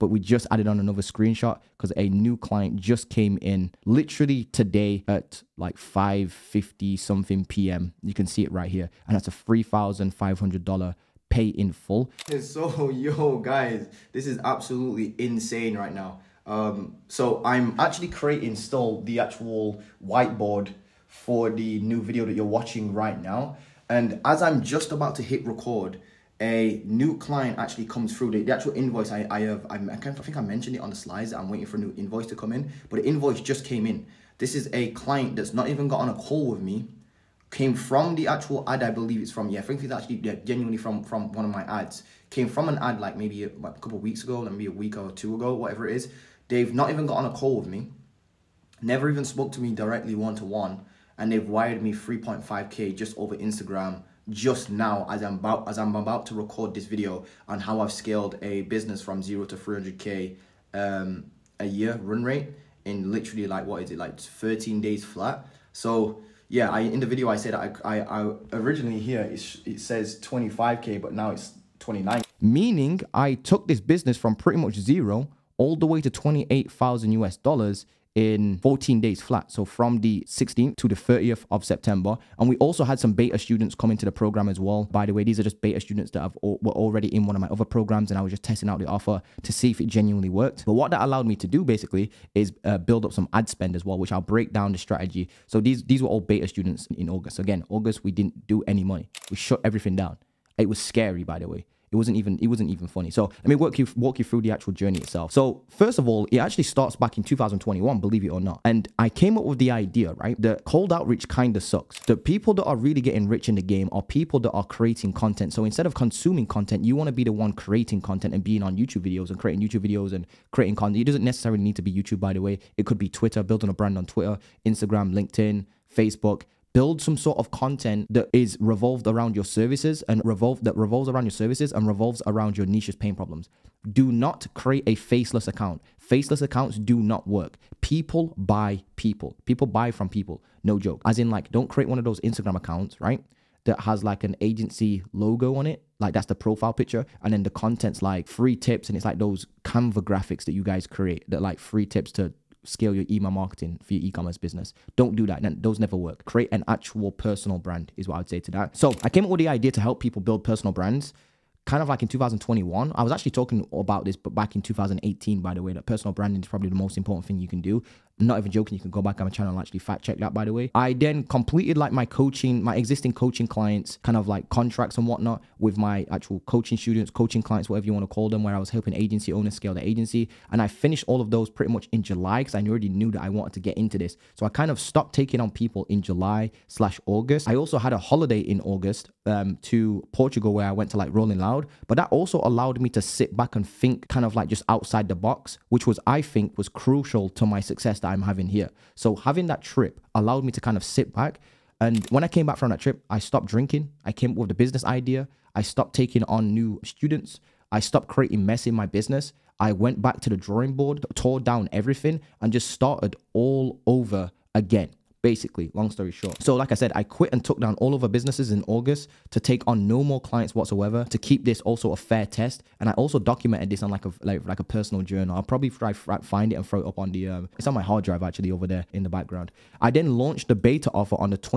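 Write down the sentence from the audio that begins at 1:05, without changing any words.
So yeah, I in the video I said I I, I originally here it, it says 25k, but now it's 29.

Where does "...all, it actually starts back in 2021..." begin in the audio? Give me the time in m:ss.
1:46.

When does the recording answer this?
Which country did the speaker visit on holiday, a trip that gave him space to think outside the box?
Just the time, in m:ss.
3:10.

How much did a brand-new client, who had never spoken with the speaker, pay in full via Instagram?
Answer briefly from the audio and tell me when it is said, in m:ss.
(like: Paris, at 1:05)
$3,500, at 0:09.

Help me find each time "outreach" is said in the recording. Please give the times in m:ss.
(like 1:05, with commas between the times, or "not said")
1:50.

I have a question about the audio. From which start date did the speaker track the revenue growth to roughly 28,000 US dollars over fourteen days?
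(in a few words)
16th of September.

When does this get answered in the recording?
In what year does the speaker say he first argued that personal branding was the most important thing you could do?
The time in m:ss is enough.
2:44.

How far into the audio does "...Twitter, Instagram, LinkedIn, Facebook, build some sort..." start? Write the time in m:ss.
2:04.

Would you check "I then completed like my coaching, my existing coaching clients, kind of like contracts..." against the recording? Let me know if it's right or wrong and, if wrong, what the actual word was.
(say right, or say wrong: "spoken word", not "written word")
right.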